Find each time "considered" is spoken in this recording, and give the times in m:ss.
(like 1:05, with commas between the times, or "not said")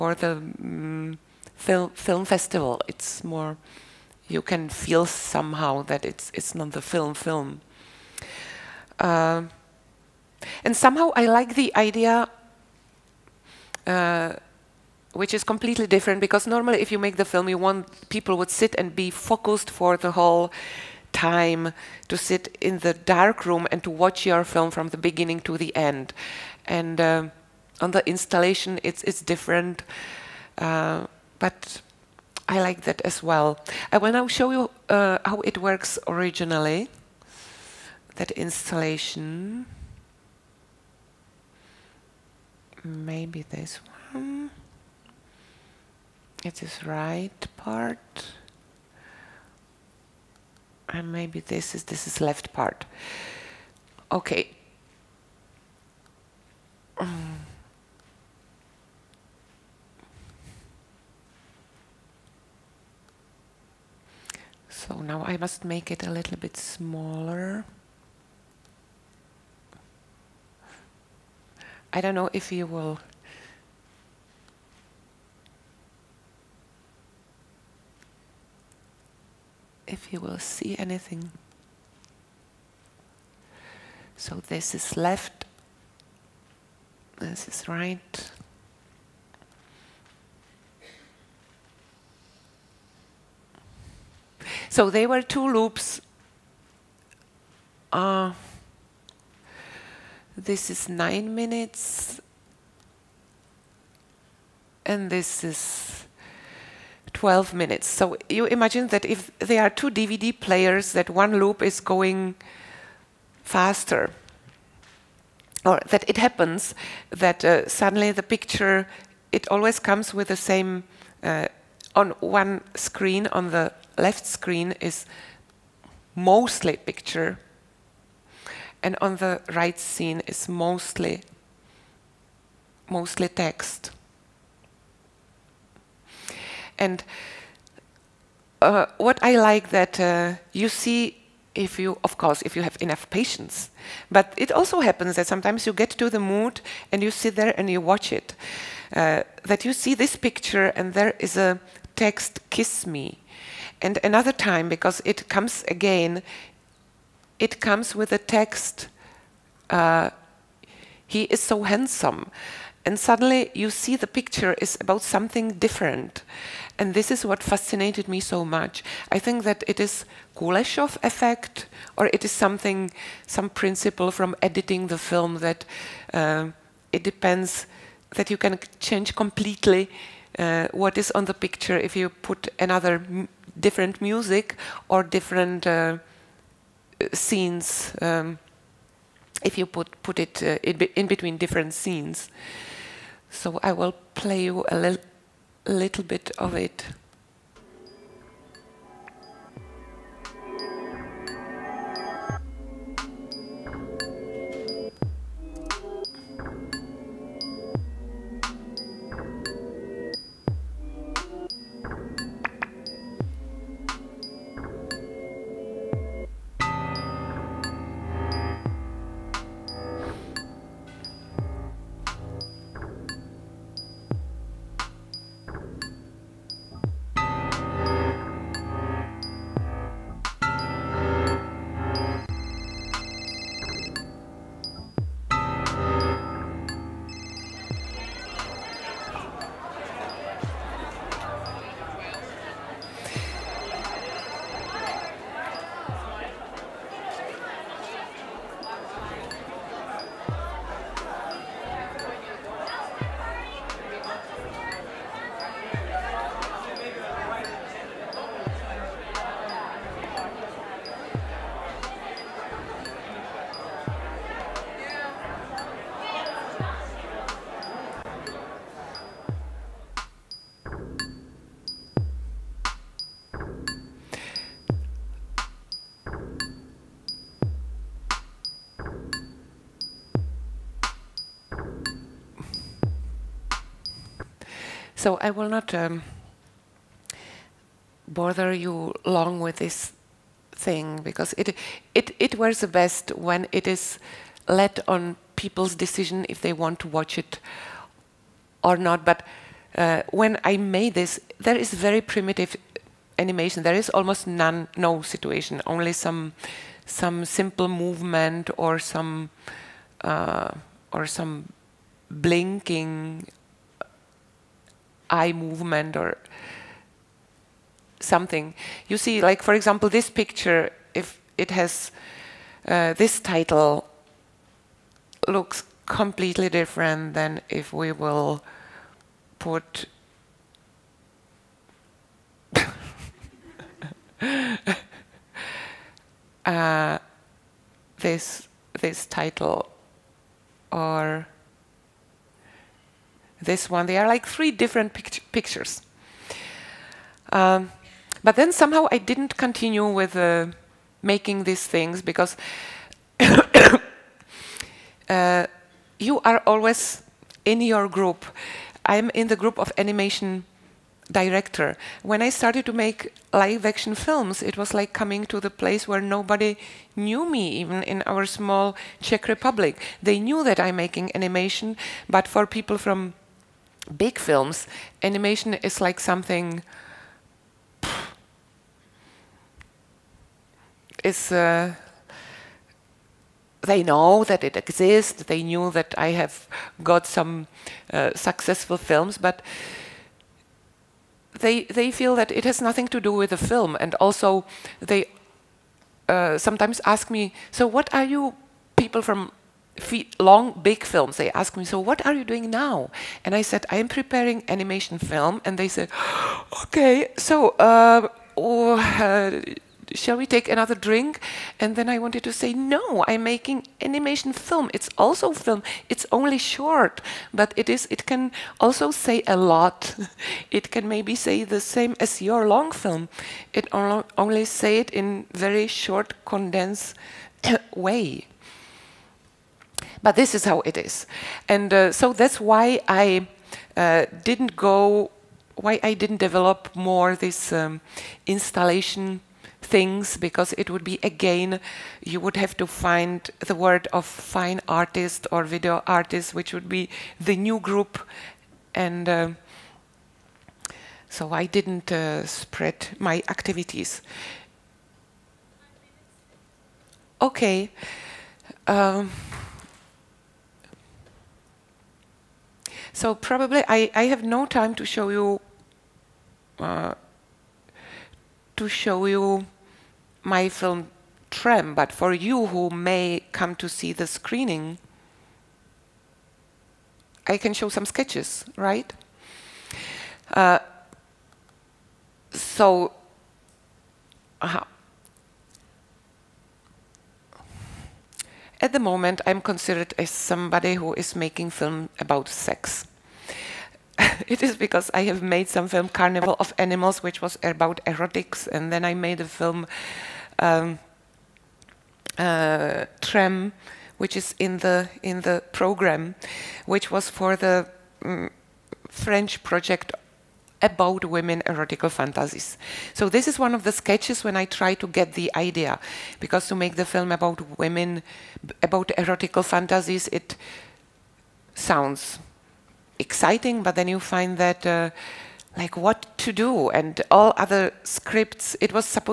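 8:09.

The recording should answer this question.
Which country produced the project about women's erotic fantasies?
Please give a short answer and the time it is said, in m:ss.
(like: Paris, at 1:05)
French, at 8:28.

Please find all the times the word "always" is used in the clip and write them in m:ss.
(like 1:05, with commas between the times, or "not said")
1:59, 5:56.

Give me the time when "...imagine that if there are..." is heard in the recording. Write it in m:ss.
1:48.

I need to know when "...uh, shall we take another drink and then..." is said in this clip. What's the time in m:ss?
6:48.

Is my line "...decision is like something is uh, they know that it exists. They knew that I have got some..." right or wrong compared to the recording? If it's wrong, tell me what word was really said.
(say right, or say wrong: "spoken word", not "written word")
wrong: "animation", not "decision".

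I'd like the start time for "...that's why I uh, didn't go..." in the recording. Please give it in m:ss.
7:12.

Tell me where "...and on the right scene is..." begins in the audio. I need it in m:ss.
2:08.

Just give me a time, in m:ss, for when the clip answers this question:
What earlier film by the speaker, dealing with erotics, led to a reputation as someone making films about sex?
8:15.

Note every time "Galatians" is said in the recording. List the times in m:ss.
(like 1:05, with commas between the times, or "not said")
not said.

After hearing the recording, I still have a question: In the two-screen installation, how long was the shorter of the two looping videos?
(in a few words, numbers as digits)
9 minutes.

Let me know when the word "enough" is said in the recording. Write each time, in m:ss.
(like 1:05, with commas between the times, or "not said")
2:22.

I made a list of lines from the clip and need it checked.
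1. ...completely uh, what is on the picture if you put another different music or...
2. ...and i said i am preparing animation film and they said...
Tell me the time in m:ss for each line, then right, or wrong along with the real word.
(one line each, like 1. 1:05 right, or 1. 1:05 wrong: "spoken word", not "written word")
1. 2:59 right
2. 6:43 right.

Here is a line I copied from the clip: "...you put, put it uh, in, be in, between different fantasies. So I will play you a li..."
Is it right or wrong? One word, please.
wrong.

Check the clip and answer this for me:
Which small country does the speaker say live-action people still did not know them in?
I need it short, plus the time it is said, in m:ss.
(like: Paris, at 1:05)
Czech Republic, at 6:09.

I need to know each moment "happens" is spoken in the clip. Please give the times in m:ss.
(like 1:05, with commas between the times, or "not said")
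1:56, 2:24.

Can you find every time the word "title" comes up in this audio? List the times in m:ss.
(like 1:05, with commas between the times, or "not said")
5:23, 5:39.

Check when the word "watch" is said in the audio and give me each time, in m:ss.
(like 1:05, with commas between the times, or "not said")
0:23, 2:27, 4:56.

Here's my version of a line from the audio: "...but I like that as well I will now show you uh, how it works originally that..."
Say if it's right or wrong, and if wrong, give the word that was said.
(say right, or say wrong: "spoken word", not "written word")
right.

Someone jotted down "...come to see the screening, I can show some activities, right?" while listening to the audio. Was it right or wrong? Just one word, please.
wrong.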